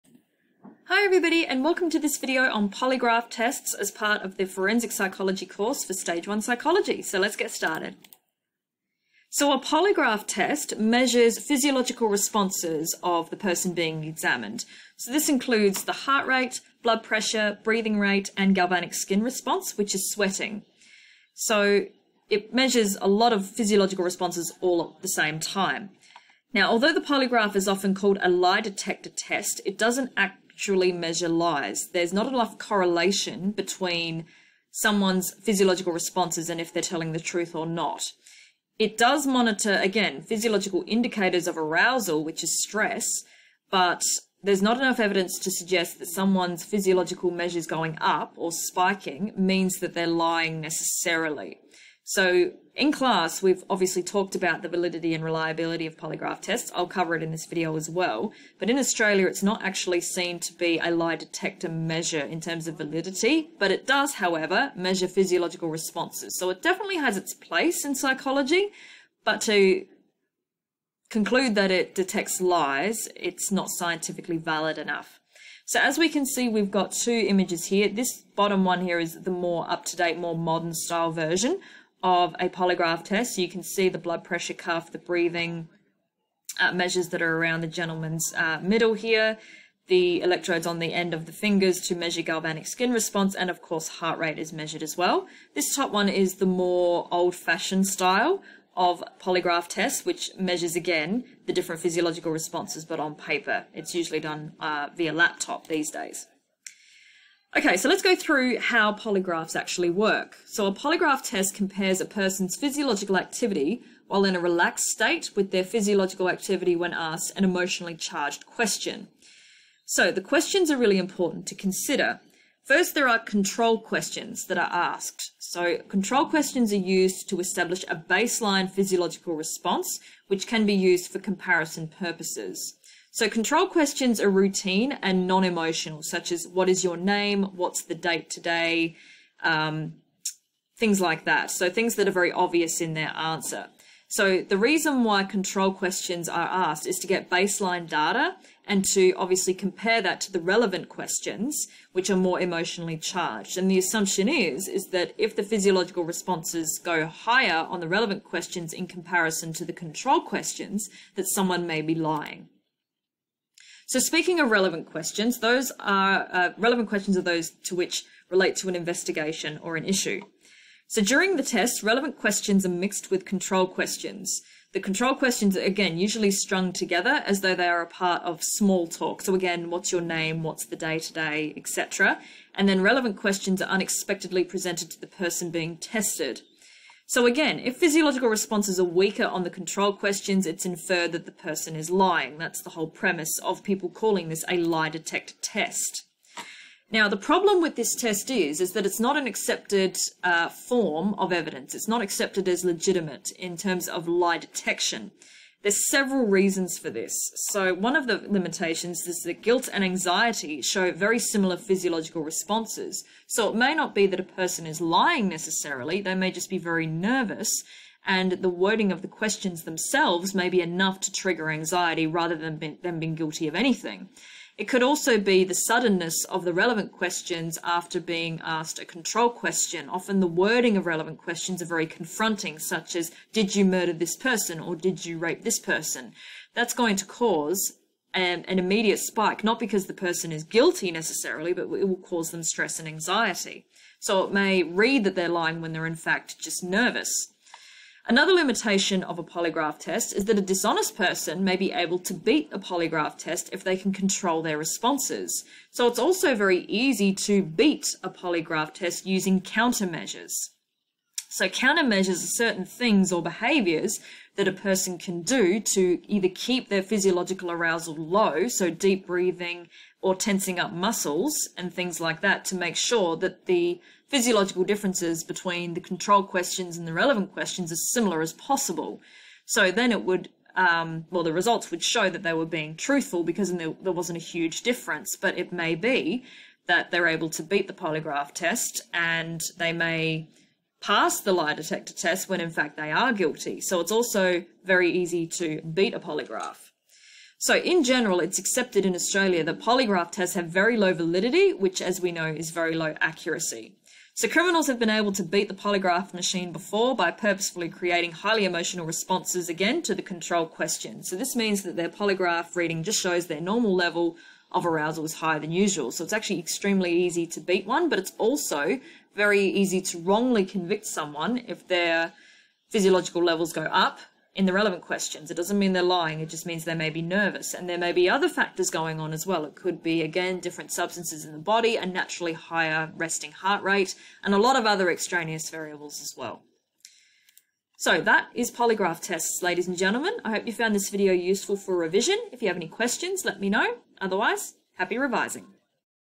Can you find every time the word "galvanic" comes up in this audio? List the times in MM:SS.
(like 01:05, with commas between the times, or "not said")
00:18, 01:32.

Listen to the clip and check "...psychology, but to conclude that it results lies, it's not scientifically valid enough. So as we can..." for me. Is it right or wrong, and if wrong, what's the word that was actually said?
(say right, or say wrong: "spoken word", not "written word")
wrong: "detects", not "results".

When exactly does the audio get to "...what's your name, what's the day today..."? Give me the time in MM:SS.
02:59.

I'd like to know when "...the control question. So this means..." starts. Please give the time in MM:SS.
05:09.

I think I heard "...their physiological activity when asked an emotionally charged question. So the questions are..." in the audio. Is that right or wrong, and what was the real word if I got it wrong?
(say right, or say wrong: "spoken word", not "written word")
right.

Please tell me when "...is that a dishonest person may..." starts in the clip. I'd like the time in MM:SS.
04:10.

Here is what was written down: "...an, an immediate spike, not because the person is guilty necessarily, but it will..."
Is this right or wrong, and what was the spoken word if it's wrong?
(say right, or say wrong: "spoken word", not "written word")
right.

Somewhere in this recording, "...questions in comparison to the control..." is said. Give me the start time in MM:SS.
02:38.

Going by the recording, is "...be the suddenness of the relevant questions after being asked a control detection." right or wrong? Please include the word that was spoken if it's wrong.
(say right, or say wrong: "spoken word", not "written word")
wrong: "question", not "detection".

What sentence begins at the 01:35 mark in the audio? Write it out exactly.
This top one is the more old-fashioned style of polygraph tests, which measures again the different physiological responses, but on paper.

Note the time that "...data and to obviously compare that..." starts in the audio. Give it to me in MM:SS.
02:27.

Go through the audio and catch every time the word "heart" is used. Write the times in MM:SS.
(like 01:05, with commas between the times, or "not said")
00:15, 01:33, 05:33.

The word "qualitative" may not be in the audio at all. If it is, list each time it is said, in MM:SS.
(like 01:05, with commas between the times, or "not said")
not said.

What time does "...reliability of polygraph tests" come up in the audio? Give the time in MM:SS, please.
00:55.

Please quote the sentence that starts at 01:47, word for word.
Okay, so let's go through how polygraphs actually work.